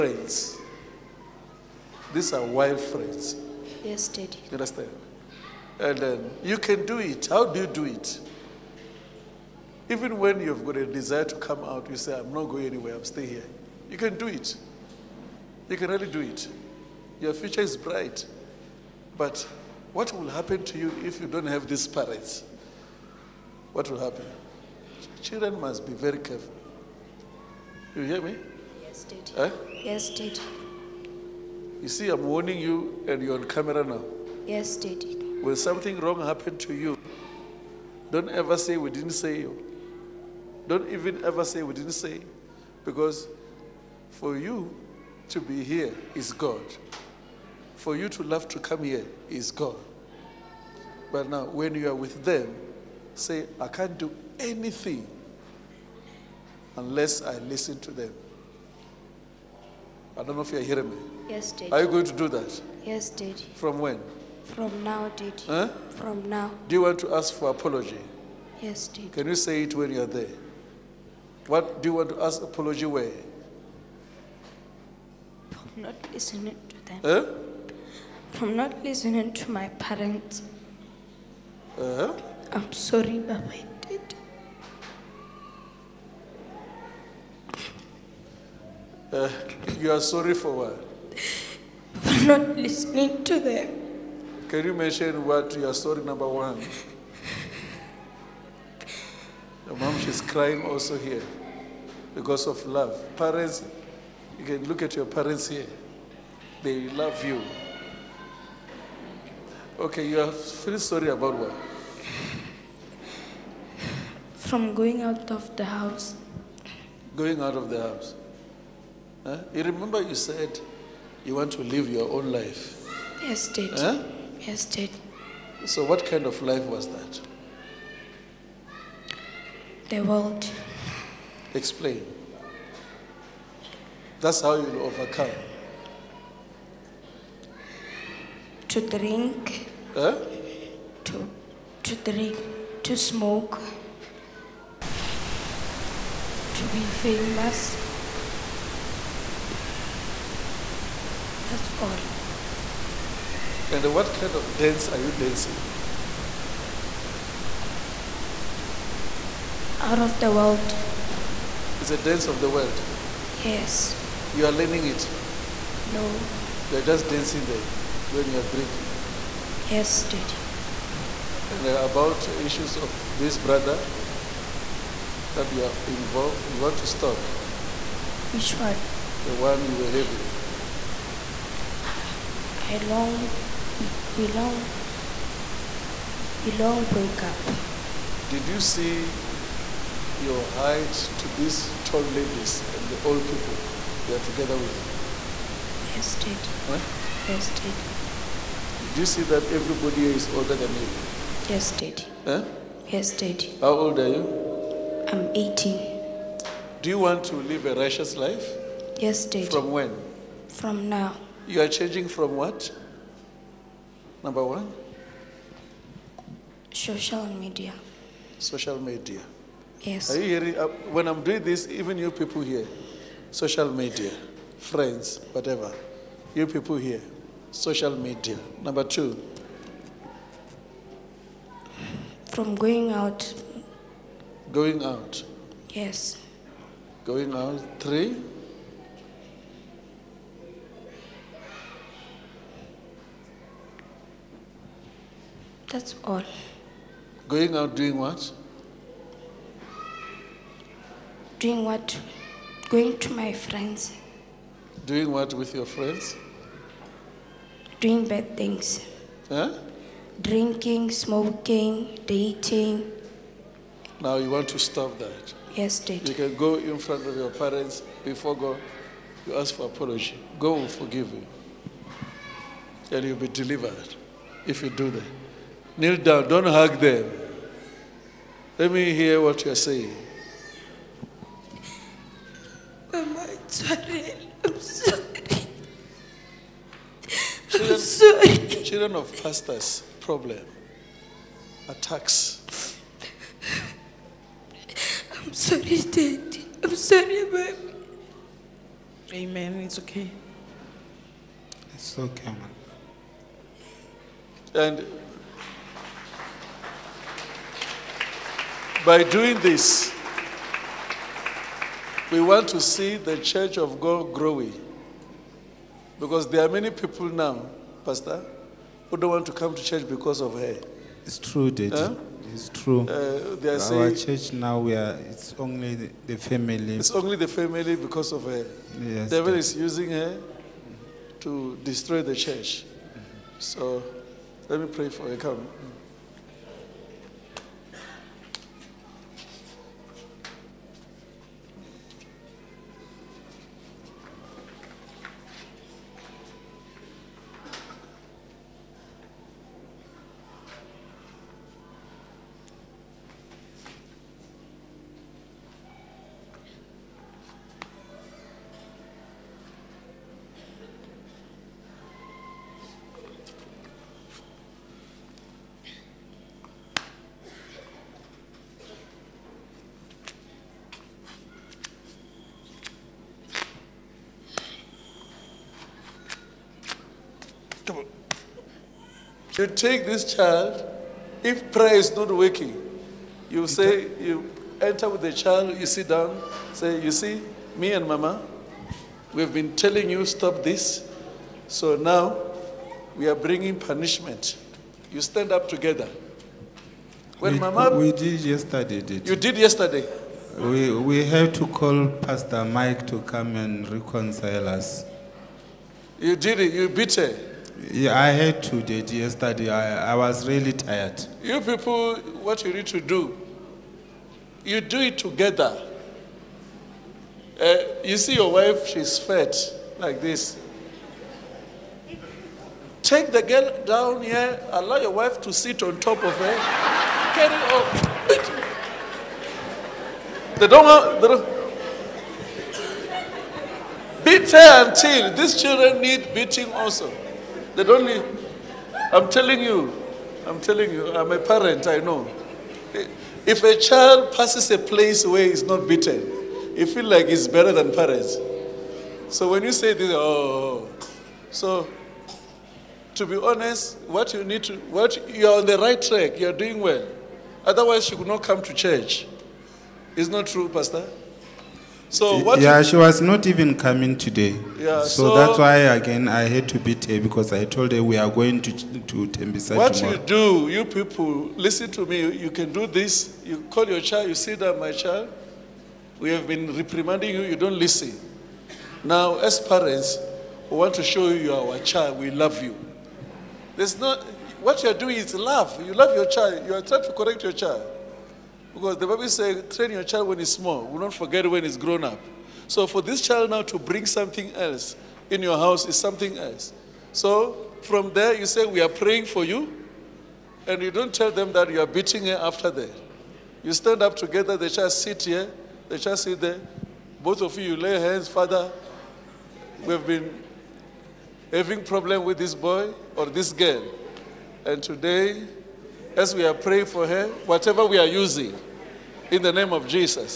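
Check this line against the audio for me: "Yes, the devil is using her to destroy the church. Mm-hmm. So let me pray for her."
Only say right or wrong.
right.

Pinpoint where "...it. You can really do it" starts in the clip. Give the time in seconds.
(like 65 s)
14 s.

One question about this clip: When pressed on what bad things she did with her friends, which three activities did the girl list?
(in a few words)
Drinking, smoking, dating.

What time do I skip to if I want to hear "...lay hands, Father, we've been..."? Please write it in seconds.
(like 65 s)
507 s.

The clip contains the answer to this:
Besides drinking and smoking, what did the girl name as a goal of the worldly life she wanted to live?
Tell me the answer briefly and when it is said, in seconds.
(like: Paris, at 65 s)
To be famous, at 146 s.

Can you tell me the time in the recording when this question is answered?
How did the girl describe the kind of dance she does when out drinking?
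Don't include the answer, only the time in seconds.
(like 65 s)
159 s.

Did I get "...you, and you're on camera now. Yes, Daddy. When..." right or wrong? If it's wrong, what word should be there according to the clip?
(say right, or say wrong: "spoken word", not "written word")
right.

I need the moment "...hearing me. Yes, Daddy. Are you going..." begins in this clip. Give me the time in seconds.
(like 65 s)
60 s.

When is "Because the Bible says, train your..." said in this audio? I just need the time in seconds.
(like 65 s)
488 s.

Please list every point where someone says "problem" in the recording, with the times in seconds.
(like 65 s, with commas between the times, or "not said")
289 s, 511 s.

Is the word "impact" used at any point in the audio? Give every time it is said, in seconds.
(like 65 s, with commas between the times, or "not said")
not said.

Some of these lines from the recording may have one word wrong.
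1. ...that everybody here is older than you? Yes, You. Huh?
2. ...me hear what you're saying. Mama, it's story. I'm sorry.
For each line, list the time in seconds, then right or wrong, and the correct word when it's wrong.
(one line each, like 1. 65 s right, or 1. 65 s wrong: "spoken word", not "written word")
1. 199 s wrong: "Daddy", not "You"
2. 278 s wrong: "sorry", not "story".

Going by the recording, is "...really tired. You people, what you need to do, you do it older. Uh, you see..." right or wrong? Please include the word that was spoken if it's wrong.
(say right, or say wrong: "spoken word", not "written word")
wrong: "together", not "older".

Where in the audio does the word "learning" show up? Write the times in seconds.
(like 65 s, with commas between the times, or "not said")
164 s.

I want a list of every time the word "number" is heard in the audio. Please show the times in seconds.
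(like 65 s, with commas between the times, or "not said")
96 s, 214 s, 228 s.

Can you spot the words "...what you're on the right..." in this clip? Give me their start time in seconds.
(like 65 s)
454 s.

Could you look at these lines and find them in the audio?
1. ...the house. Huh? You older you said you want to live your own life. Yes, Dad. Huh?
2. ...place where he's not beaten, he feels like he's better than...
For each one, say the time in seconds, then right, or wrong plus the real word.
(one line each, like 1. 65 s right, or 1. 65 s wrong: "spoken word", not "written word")
1. 117 s wrong: "remember", not "older"
2. 444 s right.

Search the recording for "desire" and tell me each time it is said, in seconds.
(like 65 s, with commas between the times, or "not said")
10 s.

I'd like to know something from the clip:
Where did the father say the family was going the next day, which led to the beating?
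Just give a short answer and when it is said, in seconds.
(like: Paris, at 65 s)
Tembisa, at 469 s.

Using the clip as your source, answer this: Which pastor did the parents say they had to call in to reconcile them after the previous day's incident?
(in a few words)
Pastor Mike.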